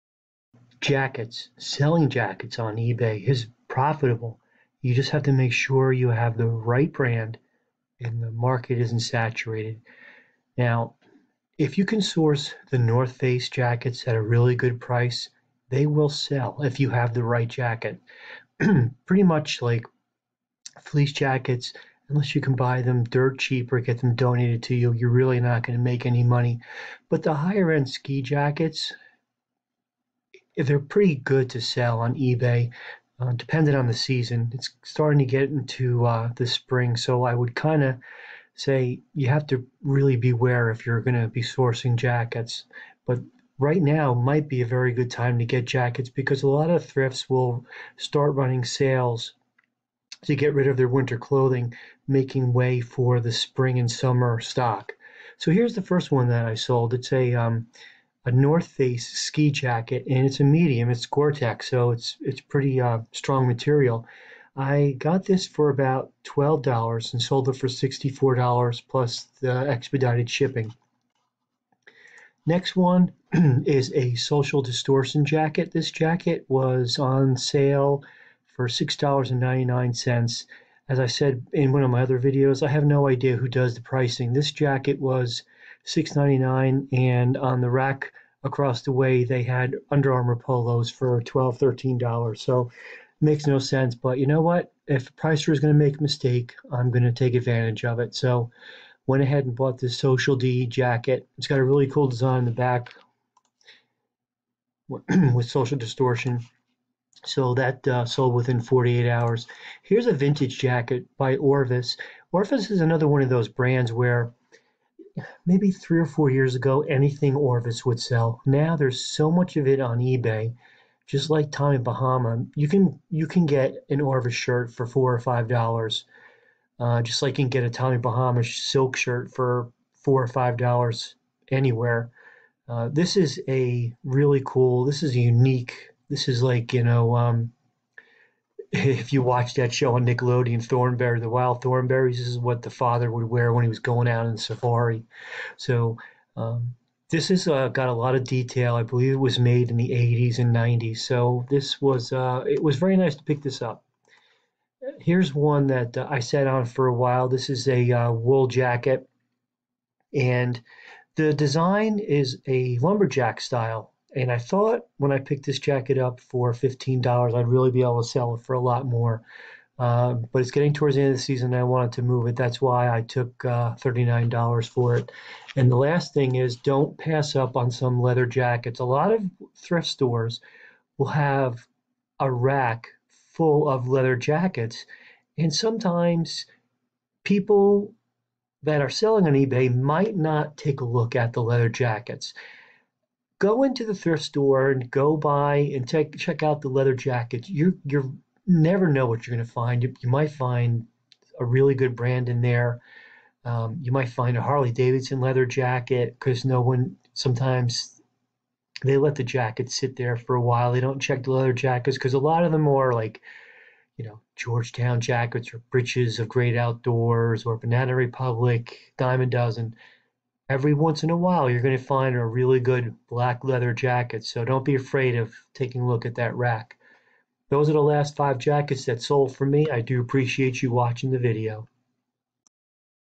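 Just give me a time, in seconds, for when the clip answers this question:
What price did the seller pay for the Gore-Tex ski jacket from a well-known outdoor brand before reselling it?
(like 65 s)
66 s.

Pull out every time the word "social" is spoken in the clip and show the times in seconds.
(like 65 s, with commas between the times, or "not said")
74 s, 99 s, 105 s.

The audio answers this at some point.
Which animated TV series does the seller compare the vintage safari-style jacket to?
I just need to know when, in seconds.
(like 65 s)
141 s.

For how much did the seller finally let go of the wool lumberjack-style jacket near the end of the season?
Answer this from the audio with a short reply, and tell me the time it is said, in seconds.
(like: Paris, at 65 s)
$39, at 173 s.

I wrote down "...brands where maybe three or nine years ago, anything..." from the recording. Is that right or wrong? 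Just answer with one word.
wrong.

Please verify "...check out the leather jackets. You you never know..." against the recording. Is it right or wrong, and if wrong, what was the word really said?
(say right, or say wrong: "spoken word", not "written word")
right.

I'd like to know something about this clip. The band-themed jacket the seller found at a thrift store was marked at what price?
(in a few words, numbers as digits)
$6.99.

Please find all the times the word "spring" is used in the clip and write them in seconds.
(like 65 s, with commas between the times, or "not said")
36 s, 53 s.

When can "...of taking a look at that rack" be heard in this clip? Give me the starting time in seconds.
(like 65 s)
225 s.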